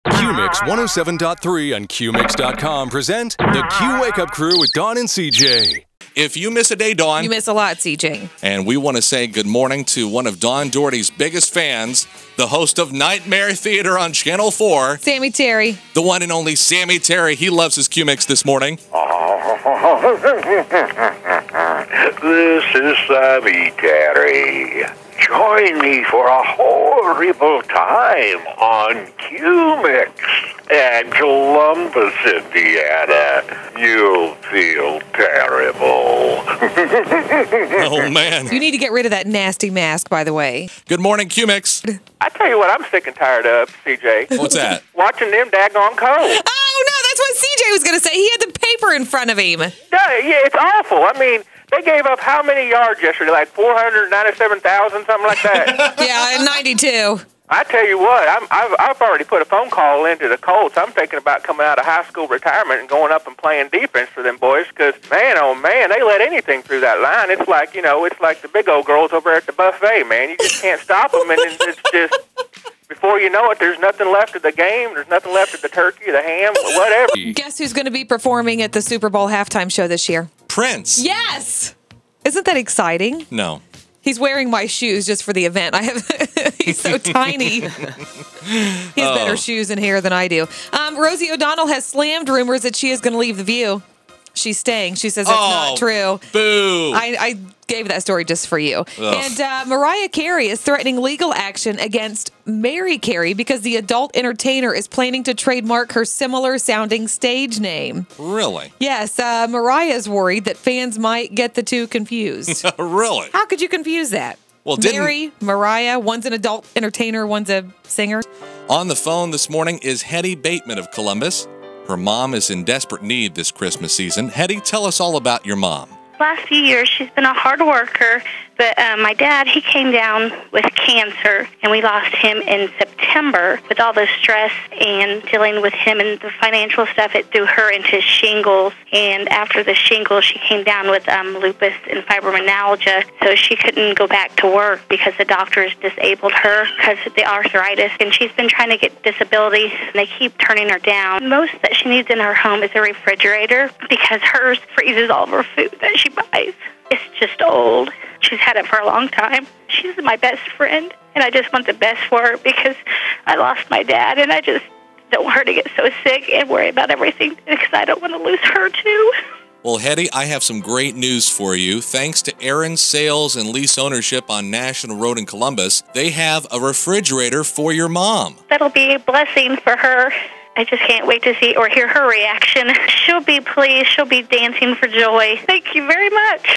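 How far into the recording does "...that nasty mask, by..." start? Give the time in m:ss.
0:39.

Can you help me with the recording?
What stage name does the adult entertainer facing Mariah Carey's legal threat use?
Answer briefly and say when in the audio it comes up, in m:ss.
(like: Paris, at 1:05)
Mary Carey, at 1:42.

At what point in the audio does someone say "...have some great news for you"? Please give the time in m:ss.
2:50.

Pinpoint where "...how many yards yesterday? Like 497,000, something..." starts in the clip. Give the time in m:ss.
0:52.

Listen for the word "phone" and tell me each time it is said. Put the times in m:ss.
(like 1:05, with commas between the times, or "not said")
0:59, 1:58.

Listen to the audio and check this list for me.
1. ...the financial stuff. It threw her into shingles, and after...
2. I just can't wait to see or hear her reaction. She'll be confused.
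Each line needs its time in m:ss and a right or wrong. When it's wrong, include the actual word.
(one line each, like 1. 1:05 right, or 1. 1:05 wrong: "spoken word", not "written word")
1. 2:16 right
2. 3:00 wrong: "pleased", not "confused".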